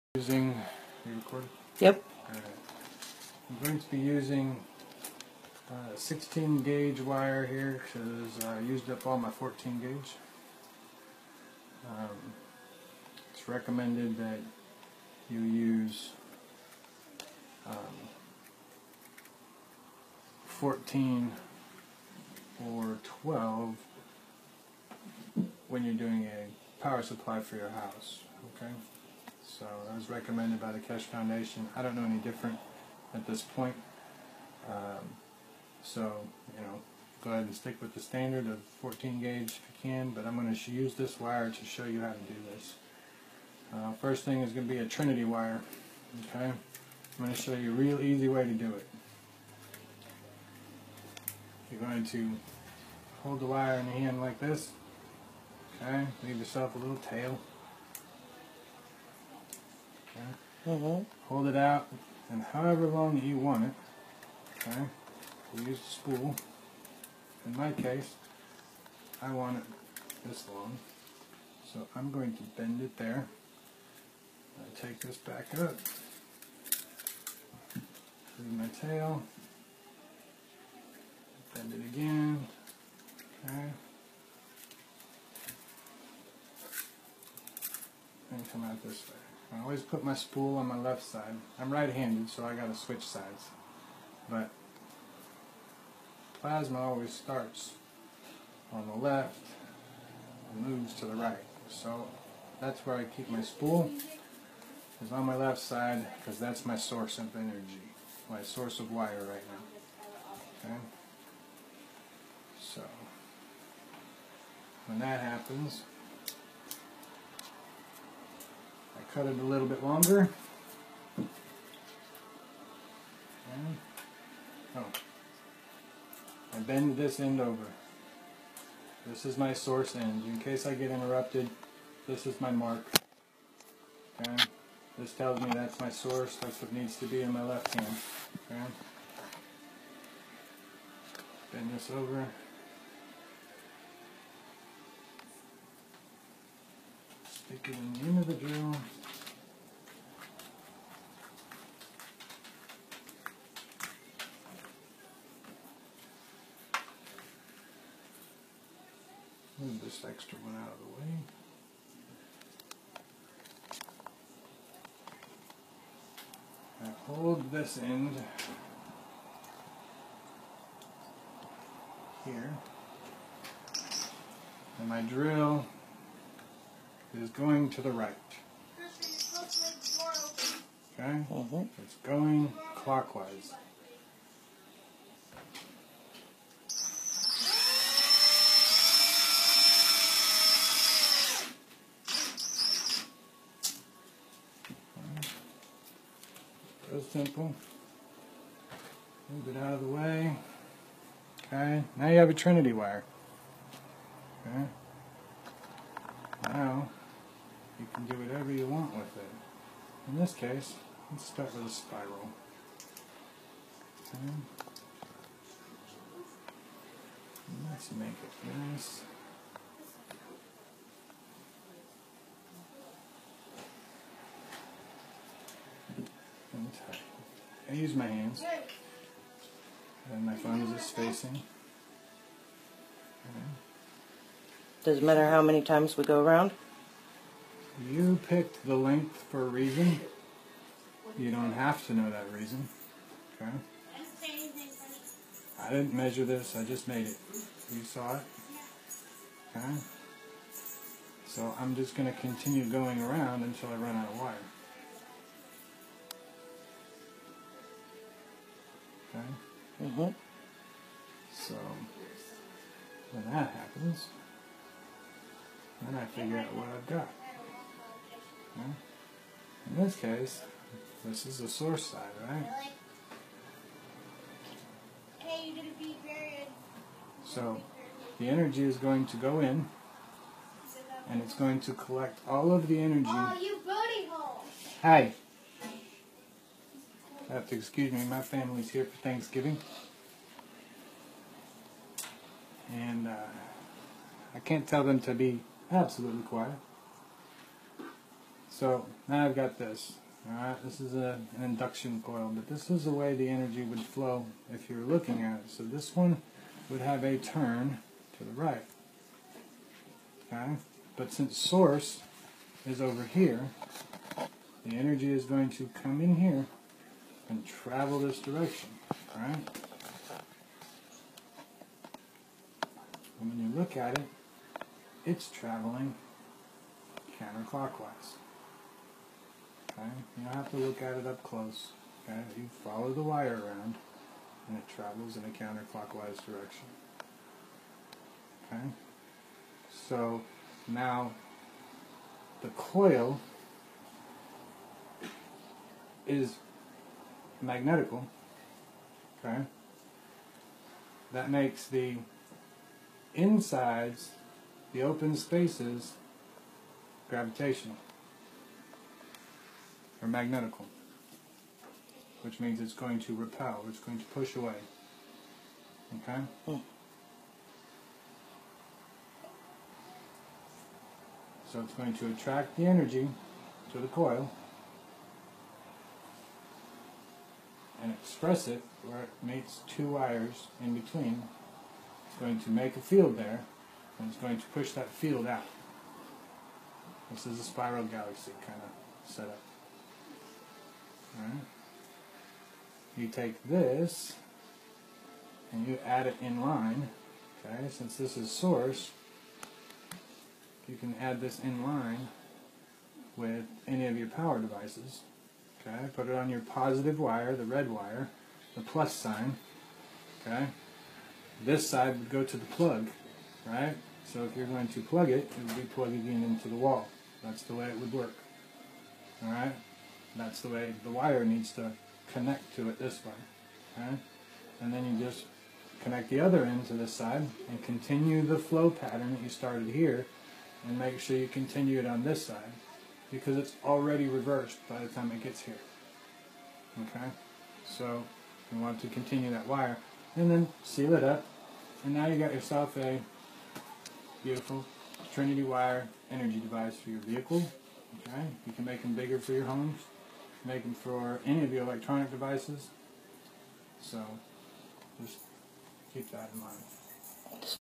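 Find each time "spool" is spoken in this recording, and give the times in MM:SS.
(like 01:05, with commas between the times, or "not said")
01:06, 01:30, 01:43.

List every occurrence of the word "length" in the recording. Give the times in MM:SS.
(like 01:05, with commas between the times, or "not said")
03:58.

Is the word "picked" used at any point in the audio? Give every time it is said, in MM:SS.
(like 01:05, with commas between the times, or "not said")
03:58.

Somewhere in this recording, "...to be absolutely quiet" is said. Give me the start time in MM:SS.
04:55.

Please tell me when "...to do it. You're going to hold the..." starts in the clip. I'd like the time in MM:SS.
00:48.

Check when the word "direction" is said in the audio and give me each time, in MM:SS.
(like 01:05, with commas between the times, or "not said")
05:18, 05:36.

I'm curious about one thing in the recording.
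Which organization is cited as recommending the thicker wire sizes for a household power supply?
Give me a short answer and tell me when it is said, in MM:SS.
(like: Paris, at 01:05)
Keshe Foundation, at 00:30.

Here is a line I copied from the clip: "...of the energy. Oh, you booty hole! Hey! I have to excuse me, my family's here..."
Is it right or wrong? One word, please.
right.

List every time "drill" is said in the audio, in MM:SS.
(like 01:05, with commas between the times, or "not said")
02:28, 02:55.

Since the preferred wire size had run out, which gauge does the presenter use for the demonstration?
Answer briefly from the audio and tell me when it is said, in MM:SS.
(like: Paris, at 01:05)
16 gauge, at 00:05.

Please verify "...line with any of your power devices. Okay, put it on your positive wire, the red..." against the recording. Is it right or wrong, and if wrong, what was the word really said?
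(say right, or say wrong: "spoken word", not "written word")
right.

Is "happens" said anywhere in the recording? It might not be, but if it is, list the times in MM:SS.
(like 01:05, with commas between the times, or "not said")
01:55, 04:23.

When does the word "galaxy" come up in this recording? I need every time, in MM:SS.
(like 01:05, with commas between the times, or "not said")
06:27.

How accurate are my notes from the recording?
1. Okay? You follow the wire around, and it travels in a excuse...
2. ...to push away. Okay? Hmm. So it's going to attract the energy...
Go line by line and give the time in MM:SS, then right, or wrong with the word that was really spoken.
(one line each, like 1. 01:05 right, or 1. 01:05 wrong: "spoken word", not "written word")
1. 05:32 wrong: "counterclockwise", not "excuse"
2. 06:03 right.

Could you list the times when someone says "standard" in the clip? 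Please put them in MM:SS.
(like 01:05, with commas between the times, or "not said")
00:37.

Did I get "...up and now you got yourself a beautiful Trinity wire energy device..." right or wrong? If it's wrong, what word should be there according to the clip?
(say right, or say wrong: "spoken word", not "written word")
right.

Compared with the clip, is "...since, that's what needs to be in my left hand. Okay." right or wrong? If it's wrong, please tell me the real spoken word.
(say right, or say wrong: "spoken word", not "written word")
wrong: "source", not "since".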